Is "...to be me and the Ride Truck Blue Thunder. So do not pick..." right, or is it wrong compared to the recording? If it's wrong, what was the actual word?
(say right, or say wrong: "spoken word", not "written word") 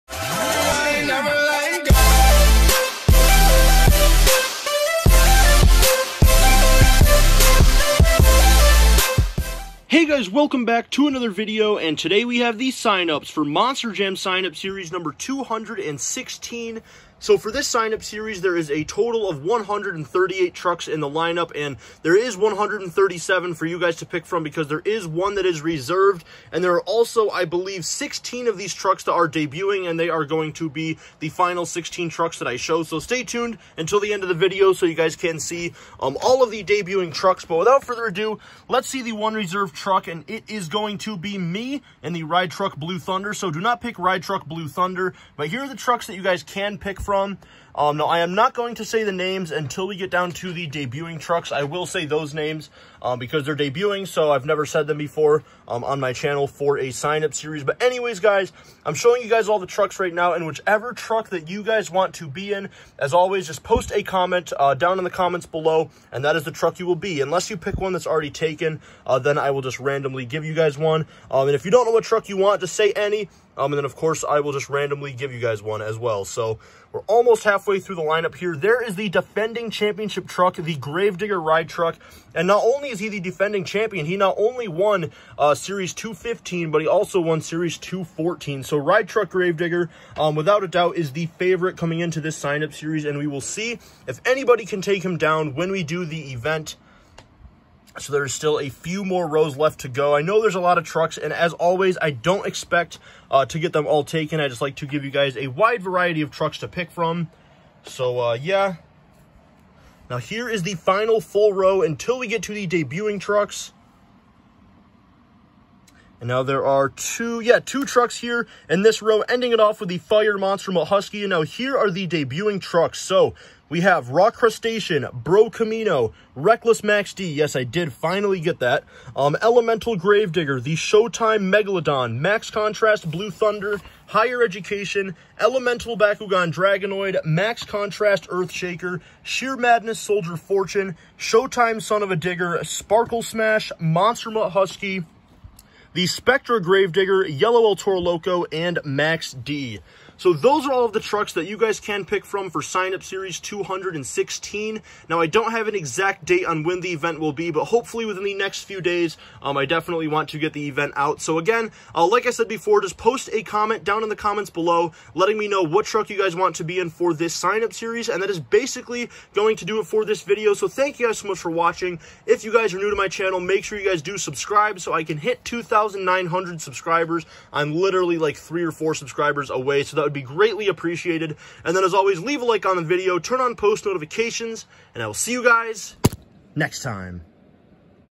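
right.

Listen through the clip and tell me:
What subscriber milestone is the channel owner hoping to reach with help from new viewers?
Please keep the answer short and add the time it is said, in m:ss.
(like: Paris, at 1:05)
2,900, at 2:55.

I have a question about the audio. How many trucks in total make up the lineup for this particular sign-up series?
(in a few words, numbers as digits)
138.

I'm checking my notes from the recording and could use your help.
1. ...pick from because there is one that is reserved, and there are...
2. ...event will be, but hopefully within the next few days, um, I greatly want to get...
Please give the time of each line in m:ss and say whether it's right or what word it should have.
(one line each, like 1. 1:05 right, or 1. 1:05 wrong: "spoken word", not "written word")
1. 0:24 right
2. 2:36 wrong: "definitely", not "greatly".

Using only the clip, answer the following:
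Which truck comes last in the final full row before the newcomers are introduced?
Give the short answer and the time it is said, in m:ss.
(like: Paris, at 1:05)
Fire Monster Husky, at 1:59.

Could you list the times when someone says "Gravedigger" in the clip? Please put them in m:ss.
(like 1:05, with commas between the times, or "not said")
1:20, 1:29, 2:09, 2:26.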